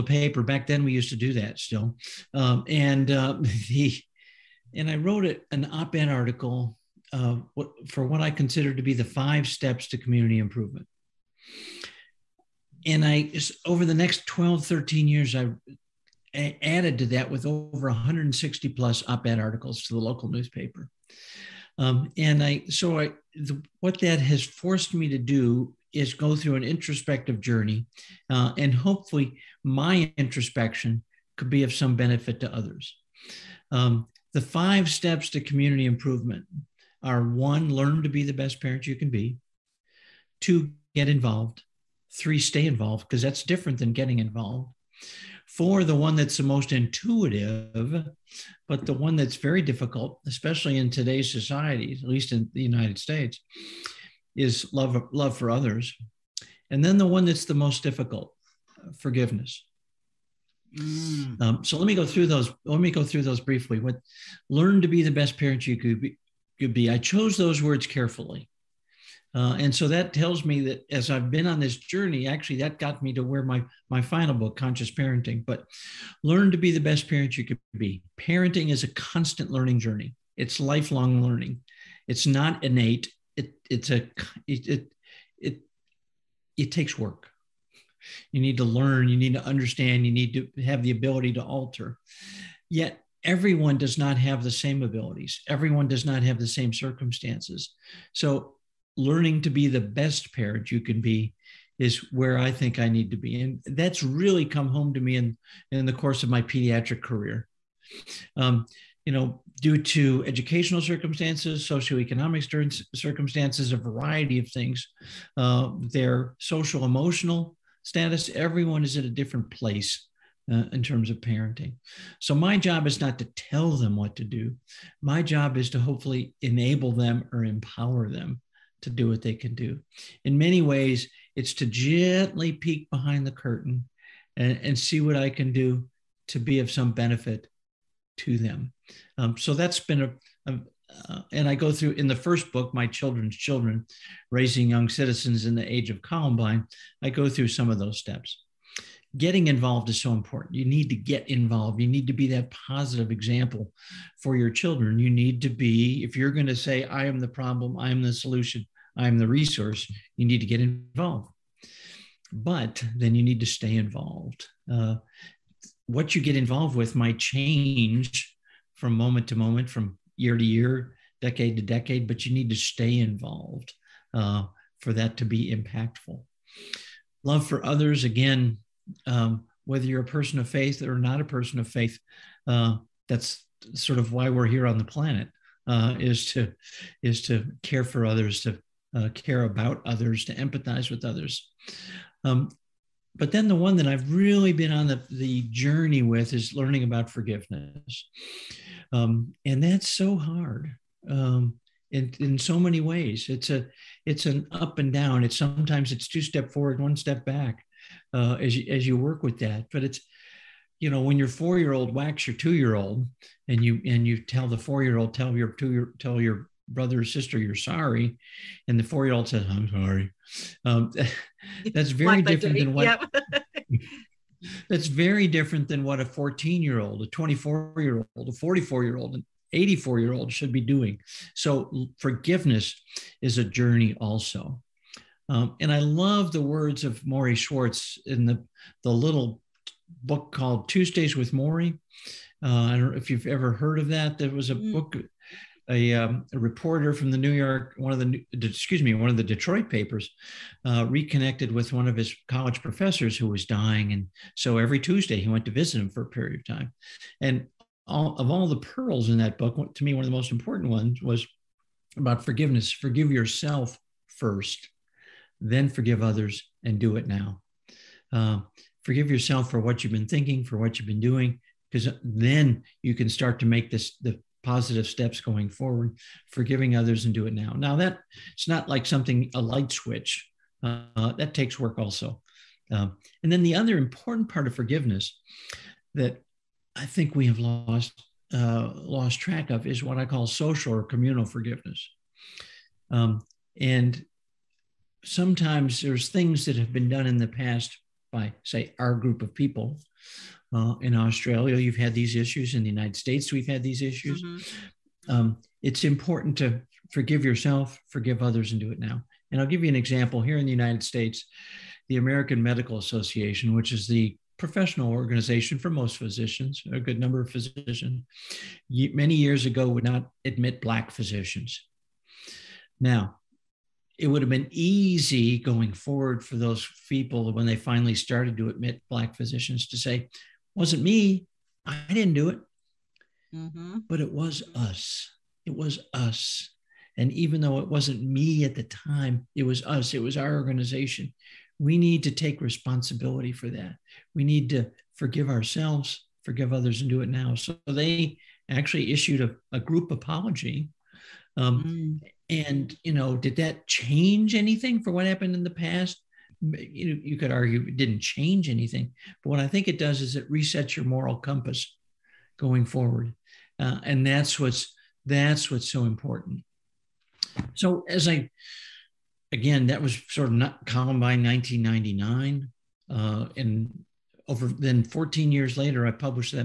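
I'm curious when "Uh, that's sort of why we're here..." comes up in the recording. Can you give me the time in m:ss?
3:02.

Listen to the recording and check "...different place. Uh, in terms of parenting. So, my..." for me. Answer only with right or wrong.
right.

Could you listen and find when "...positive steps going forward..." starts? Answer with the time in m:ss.
4:34.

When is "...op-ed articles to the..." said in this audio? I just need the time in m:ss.
0:19.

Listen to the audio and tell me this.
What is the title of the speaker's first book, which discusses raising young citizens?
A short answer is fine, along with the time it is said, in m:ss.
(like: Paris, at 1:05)
My Children's Children, at 2:22.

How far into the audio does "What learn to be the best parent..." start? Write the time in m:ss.
1:03.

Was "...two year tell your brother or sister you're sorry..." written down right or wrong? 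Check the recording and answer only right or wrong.
right.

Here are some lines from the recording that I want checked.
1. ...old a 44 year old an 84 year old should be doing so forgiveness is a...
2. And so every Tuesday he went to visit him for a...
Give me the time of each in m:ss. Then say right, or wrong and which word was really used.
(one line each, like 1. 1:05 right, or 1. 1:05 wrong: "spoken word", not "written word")
1. 3:48 right
2. 4:13 right.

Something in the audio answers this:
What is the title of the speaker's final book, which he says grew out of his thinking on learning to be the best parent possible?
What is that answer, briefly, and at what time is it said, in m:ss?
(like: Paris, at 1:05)
Conscious Parenting, at 1:14.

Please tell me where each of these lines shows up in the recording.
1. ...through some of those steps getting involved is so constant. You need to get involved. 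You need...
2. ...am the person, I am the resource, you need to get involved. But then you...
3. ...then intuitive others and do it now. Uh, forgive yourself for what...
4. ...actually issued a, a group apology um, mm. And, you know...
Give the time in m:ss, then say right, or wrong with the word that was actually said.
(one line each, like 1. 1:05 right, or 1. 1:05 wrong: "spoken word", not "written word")
1. 2:27 wrong: "important", not "constant"
2. 2:37 wrong: "solution", not "person"
3. 4:25 wrong: "forgive", not "intuitive"
4. 5:48 right.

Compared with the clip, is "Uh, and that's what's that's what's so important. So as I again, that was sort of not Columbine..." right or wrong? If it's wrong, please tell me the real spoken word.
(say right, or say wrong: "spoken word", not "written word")
right.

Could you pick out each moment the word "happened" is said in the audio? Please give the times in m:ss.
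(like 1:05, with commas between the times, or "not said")
5:55.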